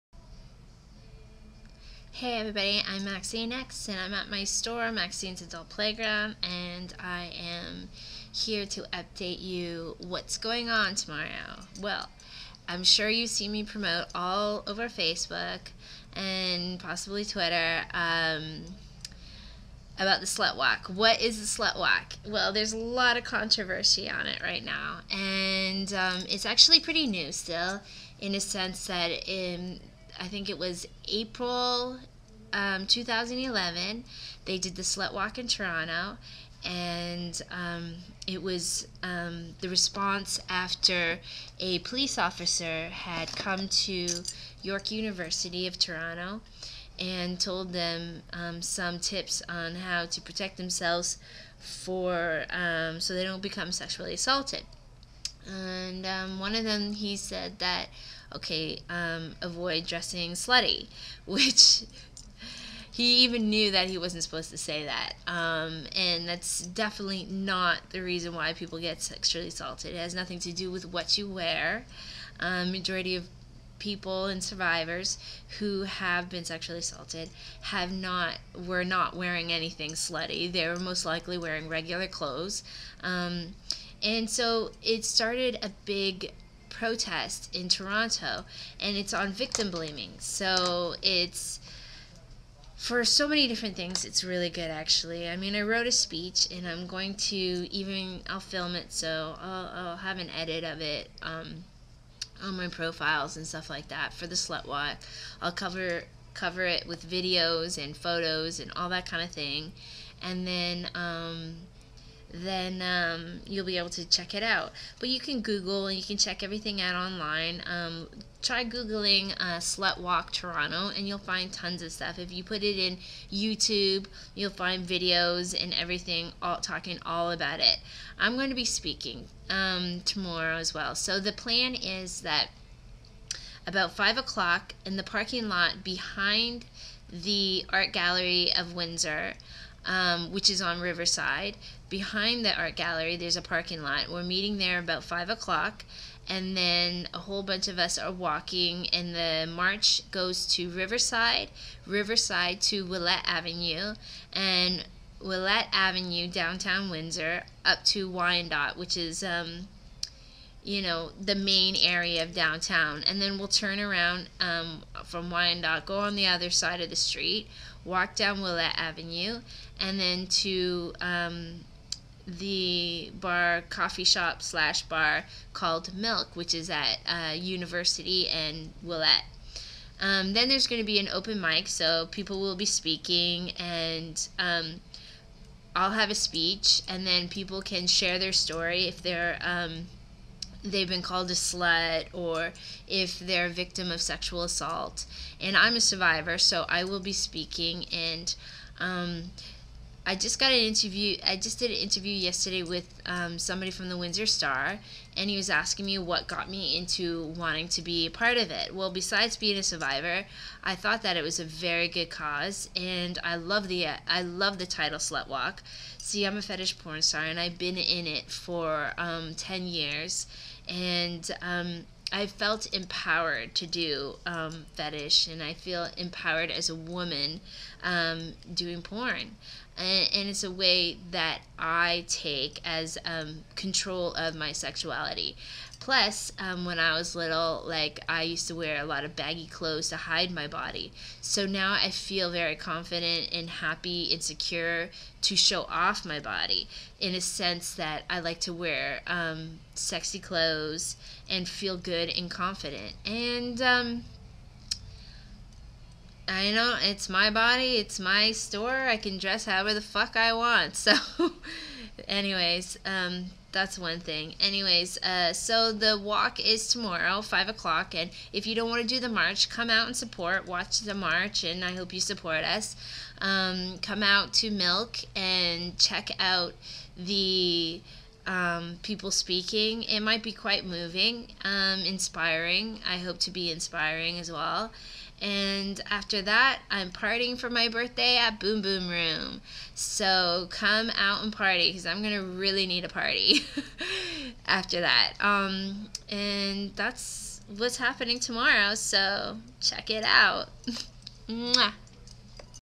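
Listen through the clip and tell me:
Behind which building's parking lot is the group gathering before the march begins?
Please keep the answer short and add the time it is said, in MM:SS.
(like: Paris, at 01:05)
Art Gallery of Windsor, at 02:17.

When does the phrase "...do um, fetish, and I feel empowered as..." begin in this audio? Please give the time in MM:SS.
03:43.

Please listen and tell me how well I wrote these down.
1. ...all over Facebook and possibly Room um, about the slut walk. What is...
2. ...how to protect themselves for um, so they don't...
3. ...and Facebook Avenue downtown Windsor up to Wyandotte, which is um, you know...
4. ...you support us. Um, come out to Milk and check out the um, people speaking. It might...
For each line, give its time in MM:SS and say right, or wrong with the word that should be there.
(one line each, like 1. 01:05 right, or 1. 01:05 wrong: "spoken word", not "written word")
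1. 00:14 wrong: "Twitter", not "Room"
2. 00:49 right
3. 02:34 wrong: "Ouellette", not "Facebook"
4. 04:31 right.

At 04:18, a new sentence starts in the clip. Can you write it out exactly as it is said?
I can dress however the fuck I want.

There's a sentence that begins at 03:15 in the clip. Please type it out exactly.
And I'm a survivor, so I will be speaking and.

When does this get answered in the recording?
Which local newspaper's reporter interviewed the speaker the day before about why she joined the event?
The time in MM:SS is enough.
03:23.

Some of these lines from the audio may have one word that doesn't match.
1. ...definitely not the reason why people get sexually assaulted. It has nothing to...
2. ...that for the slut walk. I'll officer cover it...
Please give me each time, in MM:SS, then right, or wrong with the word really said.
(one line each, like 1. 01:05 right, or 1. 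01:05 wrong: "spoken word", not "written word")
1. 01:06 right
2. 01:43 wrong: "cover", not "officer".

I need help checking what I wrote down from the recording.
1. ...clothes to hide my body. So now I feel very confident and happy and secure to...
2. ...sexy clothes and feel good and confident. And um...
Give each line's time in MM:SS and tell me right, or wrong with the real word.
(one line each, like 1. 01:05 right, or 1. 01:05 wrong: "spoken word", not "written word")
1. 03:59 right
2. 04:09 right.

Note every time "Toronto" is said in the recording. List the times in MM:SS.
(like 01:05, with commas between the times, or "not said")
00:35, 00:45, 01:27, 02:00.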